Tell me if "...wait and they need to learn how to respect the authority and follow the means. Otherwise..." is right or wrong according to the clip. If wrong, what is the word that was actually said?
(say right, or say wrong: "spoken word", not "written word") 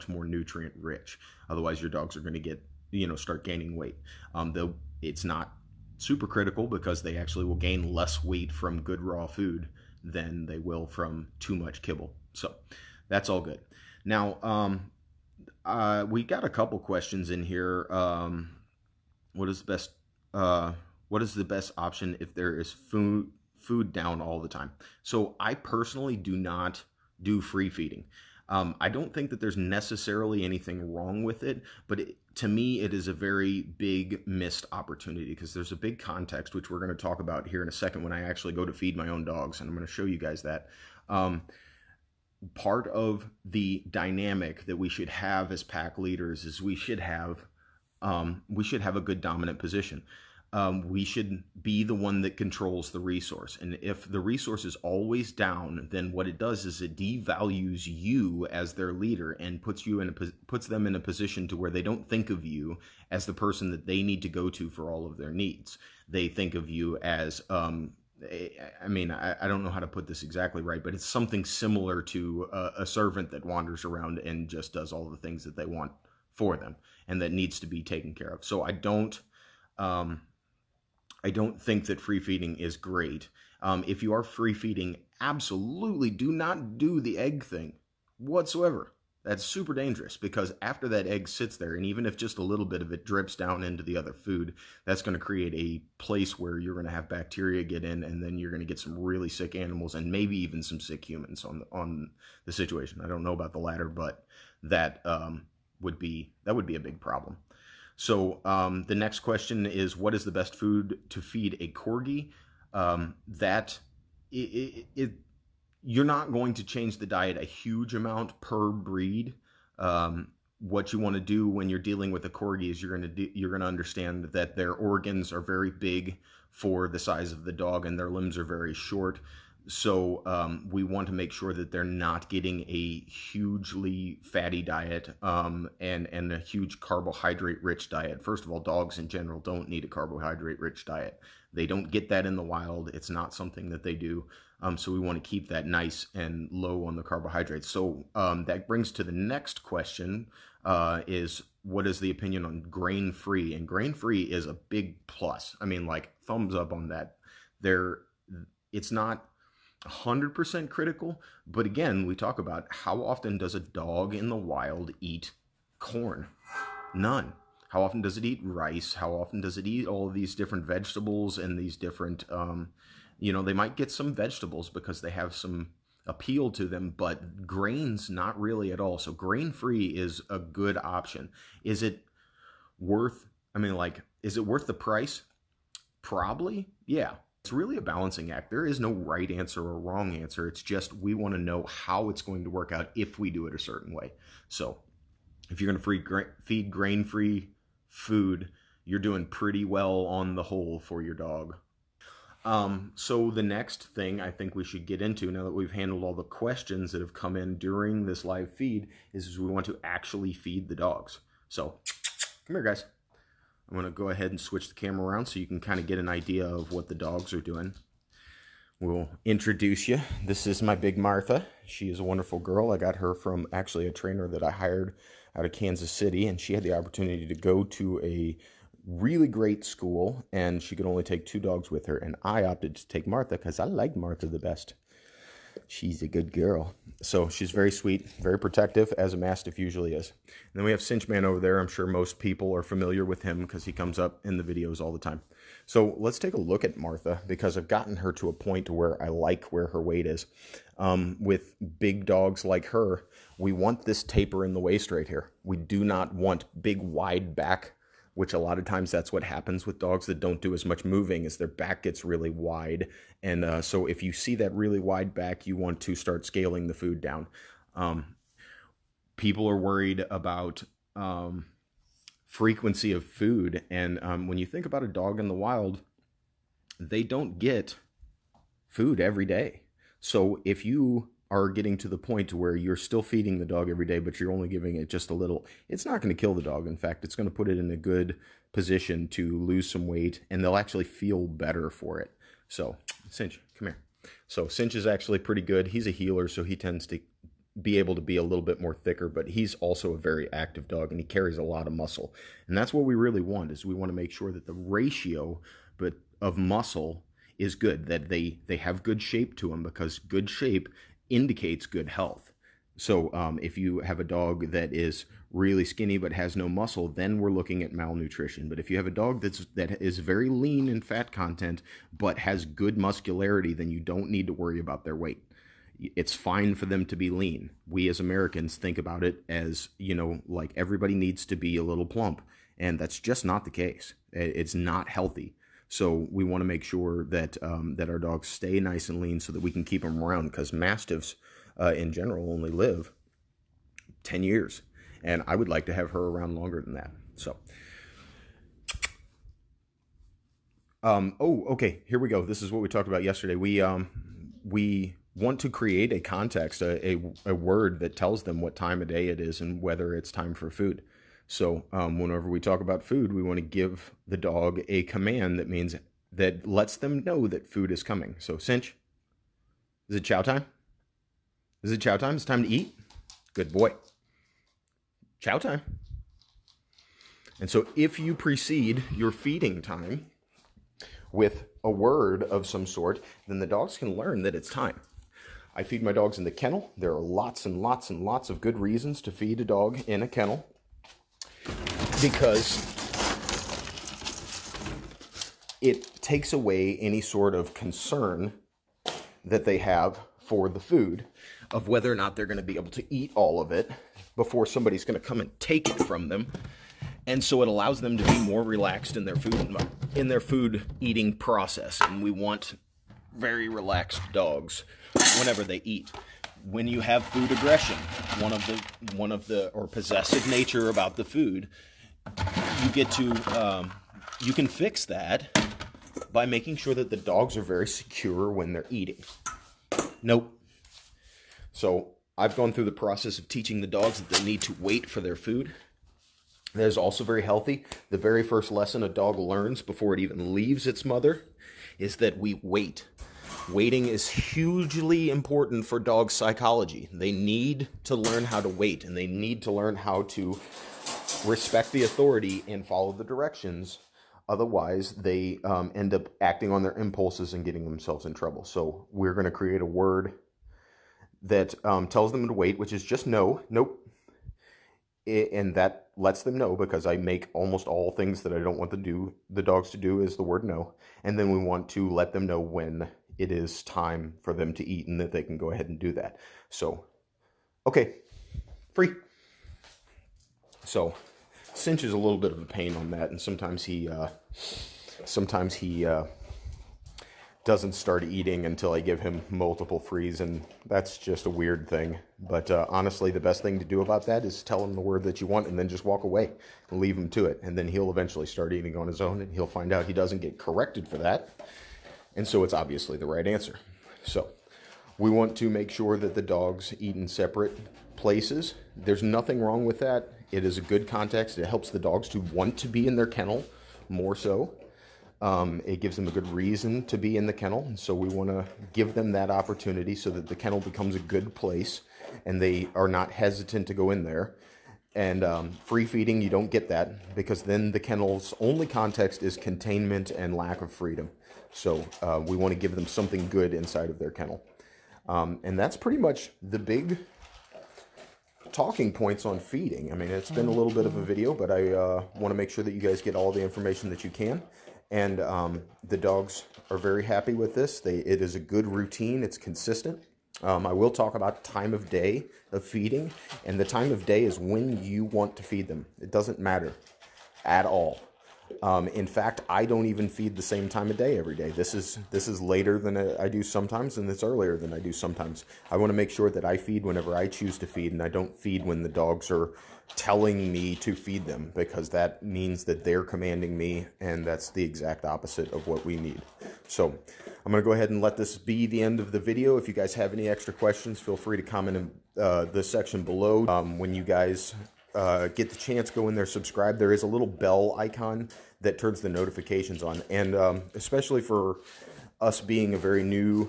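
wrong: "directions", not "means".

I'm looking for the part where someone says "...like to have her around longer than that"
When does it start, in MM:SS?
05:45.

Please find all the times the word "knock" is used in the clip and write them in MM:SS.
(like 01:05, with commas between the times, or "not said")
not said.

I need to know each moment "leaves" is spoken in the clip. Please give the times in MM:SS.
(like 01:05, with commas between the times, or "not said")
07:20, 08:16.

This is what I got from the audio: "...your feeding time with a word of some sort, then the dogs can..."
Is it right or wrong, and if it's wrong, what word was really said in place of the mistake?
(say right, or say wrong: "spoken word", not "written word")
right.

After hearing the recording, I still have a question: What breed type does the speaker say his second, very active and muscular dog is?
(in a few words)
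Heeler.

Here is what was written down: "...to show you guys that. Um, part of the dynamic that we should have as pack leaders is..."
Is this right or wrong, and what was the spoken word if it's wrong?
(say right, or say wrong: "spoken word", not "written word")
right.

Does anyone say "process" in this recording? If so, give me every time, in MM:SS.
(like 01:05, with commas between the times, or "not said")
06:51, 07:12.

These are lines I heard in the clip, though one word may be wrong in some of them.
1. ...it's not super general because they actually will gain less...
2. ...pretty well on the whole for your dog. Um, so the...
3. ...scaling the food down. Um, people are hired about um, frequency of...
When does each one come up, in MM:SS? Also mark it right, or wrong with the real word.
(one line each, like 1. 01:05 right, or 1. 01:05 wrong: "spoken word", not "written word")
1. 00:05 wrong: "critical", not "general"
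2. 03:19 right
3. 04:26 wrong: "worried", not "hired".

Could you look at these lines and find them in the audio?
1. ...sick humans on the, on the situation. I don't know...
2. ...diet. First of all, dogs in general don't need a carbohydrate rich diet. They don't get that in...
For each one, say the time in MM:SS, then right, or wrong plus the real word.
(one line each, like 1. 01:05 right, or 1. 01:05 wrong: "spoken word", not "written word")
1. 01:40 right
2. 02:17 right.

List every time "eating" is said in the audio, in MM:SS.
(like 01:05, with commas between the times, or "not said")
06:50, 07:08, 08:08, 08:18.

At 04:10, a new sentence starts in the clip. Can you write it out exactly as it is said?
Um, with big dogs like her, we want this taper in the waist right here.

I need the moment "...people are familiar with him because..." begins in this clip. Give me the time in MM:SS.
04:02.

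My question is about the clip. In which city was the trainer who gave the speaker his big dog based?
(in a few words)
Kansas City.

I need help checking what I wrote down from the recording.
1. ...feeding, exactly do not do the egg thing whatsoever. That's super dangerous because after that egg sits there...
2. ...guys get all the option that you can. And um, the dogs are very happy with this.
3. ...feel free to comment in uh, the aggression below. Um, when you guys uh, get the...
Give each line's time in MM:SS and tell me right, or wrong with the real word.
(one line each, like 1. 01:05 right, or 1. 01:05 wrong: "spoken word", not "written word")
1. 01:24 wrong: "absolutely", not "exactly"
2. 09:02 wrong: "information", not "option"
3. 09:40 wrong: "section", not "aggression".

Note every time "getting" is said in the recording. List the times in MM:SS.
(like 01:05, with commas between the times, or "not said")
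02:12, 04:41, 07:37.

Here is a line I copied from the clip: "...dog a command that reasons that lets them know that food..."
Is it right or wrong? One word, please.
wrong.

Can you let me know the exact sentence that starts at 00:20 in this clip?
Uh, what is the best option if there is food food down all the time?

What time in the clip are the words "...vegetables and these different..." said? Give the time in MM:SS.
02:50.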